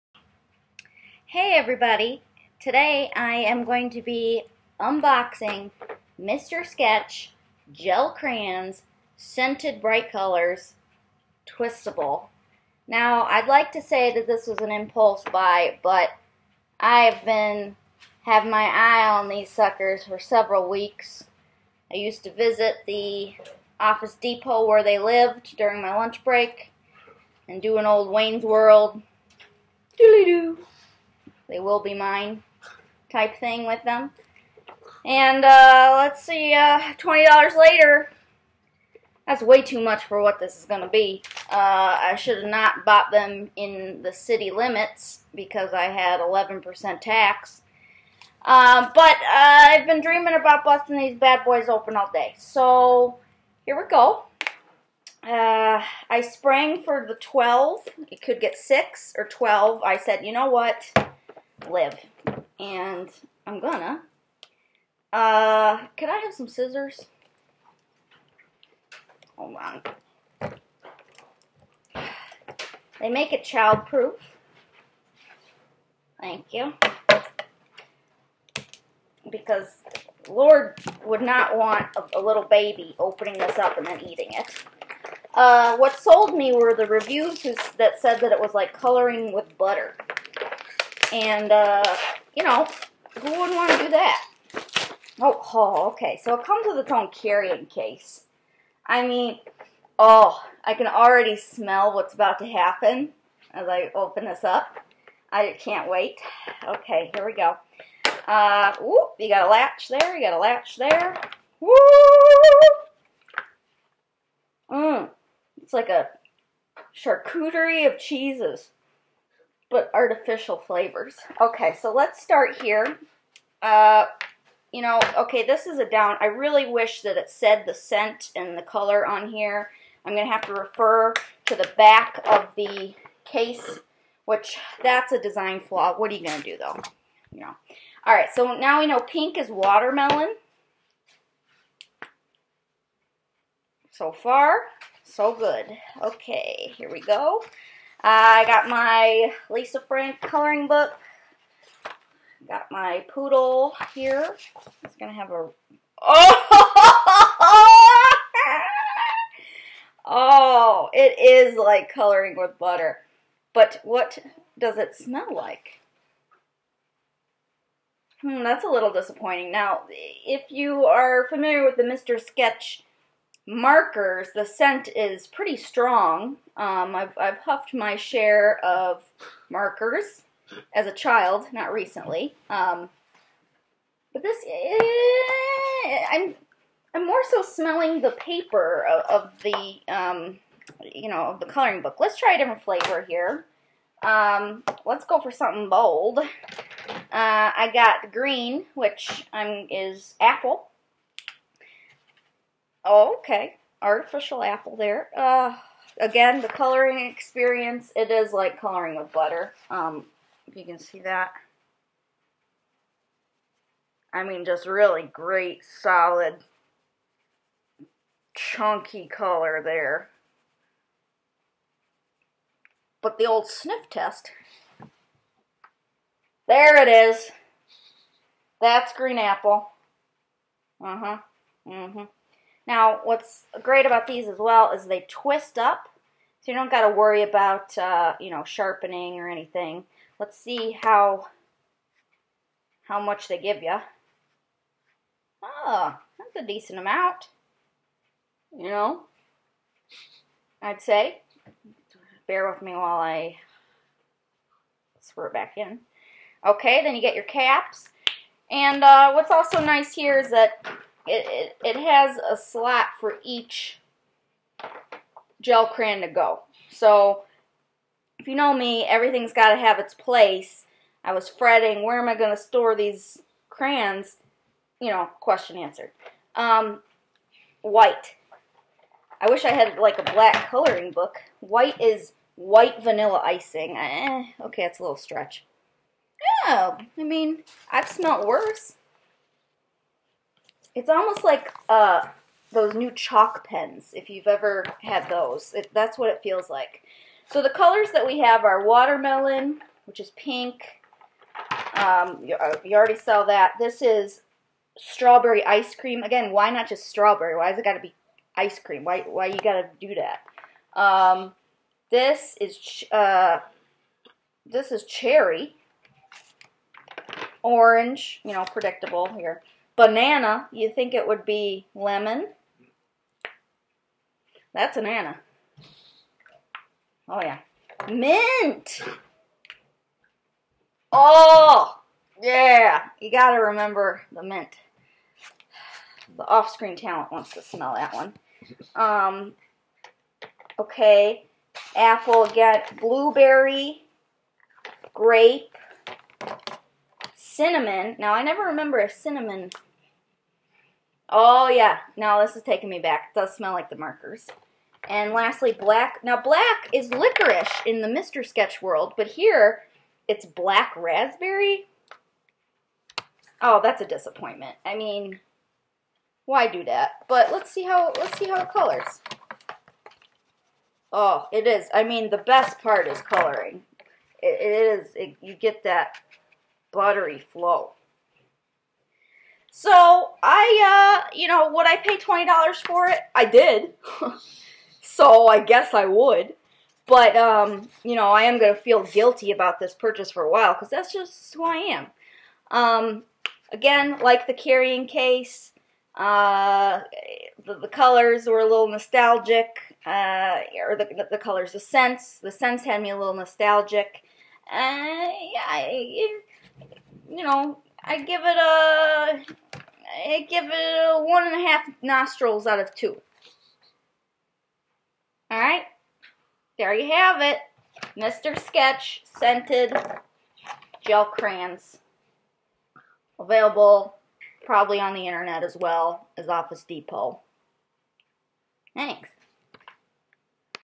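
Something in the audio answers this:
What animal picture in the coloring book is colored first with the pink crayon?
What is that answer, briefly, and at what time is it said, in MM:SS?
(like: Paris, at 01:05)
Poodle, at 02:33.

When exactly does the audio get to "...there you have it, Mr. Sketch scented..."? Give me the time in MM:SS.
06:56.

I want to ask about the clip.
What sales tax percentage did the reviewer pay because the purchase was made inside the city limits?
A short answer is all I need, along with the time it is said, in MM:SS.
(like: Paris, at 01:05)
11%, at 00:46.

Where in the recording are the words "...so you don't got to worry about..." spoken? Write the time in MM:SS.
03:56.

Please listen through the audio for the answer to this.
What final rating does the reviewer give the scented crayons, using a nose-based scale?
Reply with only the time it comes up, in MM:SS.
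06:51.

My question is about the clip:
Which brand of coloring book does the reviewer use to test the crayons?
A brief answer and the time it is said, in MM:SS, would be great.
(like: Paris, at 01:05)
Lisa Frank, at 02:29.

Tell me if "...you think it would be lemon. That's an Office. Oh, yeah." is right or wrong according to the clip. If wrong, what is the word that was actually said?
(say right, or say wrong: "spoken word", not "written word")
wrong: "Anna", not "Office".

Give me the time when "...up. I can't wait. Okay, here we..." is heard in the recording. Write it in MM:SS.
01:44.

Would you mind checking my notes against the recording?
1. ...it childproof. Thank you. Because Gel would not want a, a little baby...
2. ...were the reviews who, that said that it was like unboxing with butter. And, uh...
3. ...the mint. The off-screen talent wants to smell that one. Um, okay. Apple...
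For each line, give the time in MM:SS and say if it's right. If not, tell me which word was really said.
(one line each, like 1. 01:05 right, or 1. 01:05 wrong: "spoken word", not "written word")
1. 01:13 wrong: "Lord", not "Gel"
2. 01:26 wrong: "coloring", not "unboxing"
3. 05:34 right.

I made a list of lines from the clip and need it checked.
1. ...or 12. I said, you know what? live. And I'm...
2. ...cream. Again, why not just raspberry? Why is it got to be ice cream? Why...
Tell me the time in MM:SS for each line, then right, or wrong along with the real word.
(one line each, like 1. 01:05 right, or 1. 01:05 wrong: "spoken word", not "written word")
1. 00:59 right
2. 05:05 wrong: "strawberry", not "raspberry".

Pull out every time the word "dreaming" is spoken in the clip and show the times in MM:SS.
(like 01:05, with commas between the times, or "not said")
00:50.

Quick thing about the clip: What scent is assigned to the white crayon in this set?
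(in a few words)
Vanilla icing.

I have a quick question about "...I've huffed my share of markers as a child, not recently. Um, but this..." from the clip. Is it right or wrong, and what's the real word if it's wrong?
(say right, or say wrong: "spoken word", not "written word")
right.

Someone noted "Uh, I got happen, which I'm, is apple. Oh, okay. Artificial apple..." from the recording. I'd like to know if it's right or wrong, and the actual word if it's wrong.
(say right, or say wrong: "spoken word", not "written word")
wrong: "green", not "happen".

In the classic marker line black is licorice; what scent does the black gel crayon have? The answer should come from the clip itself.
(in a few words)
Black raspberry.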